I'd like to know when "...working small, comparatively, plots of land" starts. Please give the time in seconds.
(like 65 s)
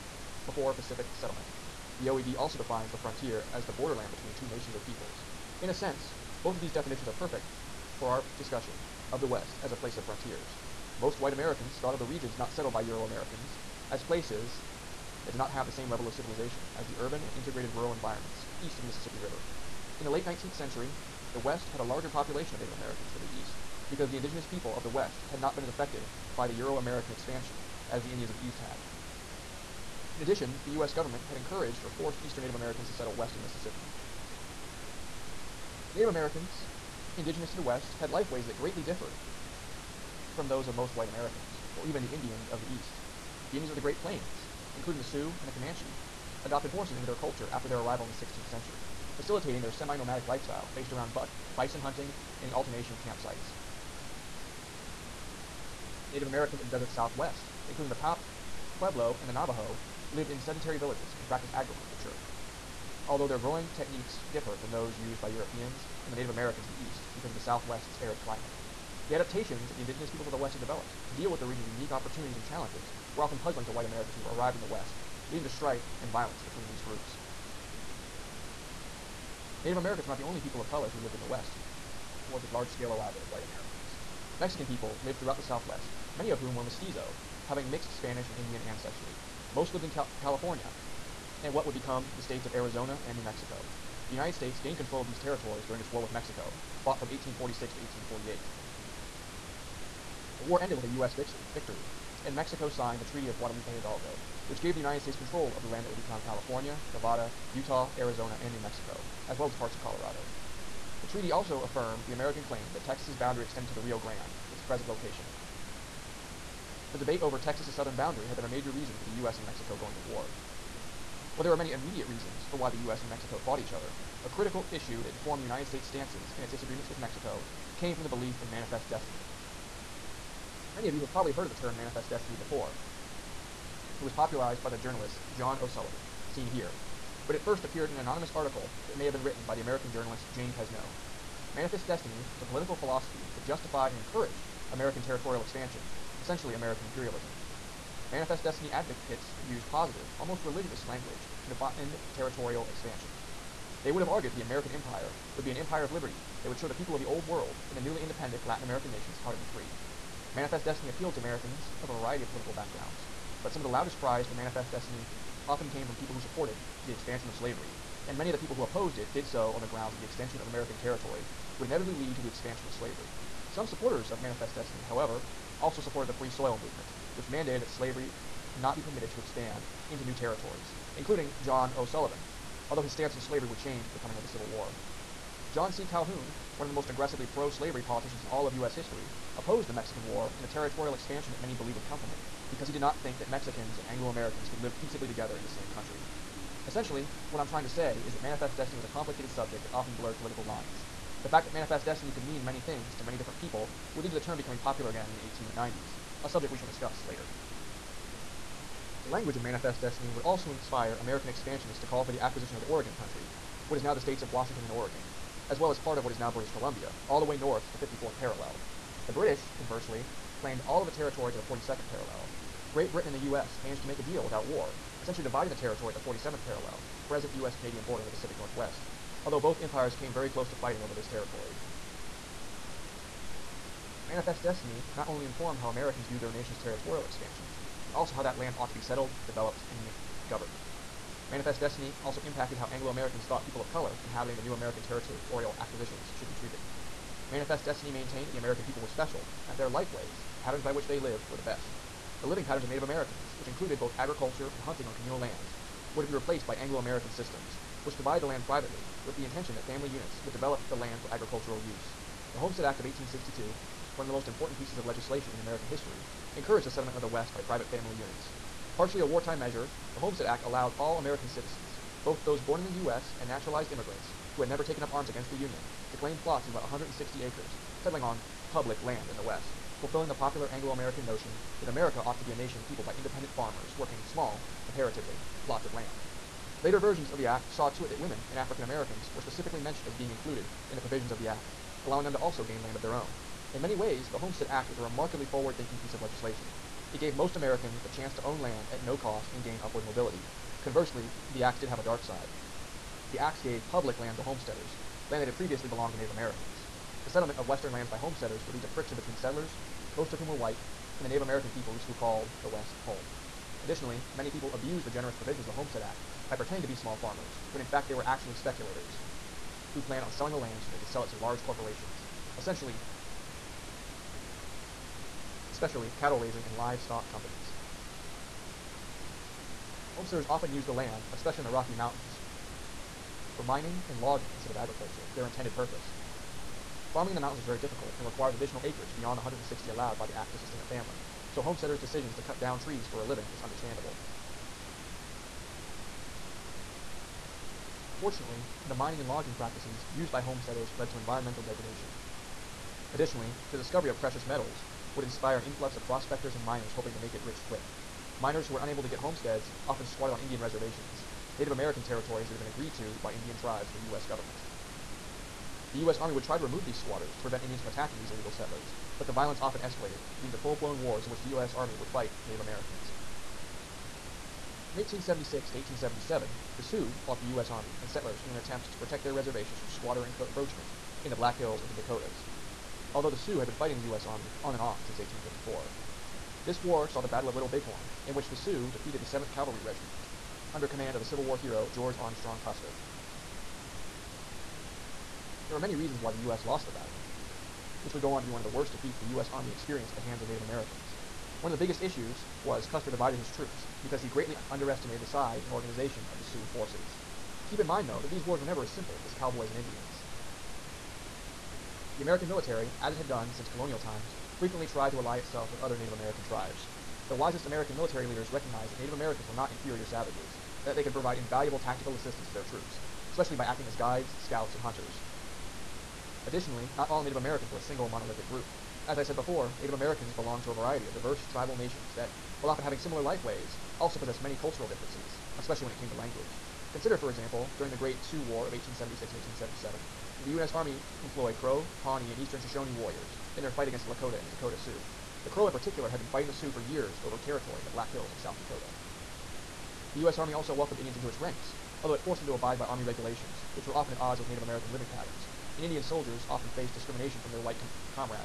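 283 s.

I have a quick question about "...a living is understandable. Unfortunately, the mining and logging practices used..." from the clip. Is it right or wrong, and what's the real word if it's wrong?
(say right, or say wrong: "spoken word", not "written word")
right.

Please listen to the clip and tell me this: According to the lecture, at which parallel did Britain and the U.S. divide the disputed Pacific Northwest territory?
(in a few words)
47th parallel.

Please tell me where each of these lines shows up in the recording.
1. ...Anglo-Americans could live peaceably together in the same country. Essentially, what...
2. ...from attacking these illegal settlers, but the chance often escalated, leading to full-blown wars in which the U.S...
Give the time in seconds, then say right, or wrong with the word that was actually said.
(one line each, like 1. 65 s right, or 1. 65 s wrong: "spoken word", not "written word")
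1. 193 s right
2. 367 s wrong: "violence", not "chance".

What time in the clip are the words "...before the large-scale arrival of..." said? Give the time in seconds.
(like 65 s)
82 s.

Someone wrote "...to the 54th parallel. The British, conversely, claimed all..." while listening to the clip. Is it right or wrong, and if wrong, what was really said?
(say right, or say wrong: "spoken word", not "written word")
right.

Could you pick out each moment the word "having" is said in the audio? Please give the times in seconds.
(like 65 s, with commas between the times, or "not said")
87 s, 432 s.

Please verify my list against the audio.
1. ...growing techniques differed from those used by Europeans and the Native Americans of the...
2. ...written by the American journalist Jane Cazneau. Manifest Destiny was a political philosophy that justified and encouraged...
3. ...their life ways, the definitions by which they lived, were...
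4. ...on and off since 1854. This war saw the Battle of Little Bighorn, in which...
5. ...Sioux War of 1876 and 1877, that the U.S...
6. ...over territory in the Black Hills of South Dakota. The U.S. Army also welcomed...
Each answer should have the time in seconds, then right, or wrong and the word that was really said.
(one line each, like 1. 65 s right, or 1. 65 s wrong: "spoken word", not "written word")
1. 63 s right
2. 139 s right
3. 249 s wrong: "patterns", not "definitions"
4. 384 s right
5. 438 s right
6. 447 s right.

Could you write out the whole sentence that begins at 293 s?
In many ways, the Homestead Act was a remarkably forward-thinking piece of legislation.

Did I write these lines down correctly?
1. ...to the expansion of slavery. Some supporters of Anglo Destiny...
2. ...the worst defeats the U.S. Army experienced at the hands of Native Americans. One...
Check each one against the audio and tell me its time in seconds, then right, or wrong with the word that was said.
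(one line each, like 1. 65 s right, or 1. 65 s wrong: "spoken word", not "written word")
1. 172 s wrong: "Manifest", not "Anglo"
2. 398 s right.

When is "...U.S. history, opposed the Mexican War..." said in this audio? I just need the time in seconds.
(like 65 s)
188 s.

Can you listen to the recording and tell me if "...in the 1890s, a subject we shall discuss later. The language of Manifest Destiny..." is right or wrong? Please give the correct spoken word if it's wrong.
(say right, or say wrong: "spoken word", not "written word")
right.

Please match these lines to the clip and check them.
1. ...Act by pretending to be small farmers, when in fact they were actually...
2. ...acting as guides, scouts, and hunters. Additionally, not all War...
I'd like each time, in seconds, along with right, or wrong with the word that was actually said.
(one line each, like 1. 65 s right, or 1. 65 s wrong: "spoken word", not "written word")
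1. 315 s right
2. 423 s wrong: "Native", not "War".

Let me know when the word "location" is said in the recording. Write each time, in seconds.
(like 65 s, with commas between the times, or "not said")
114 s.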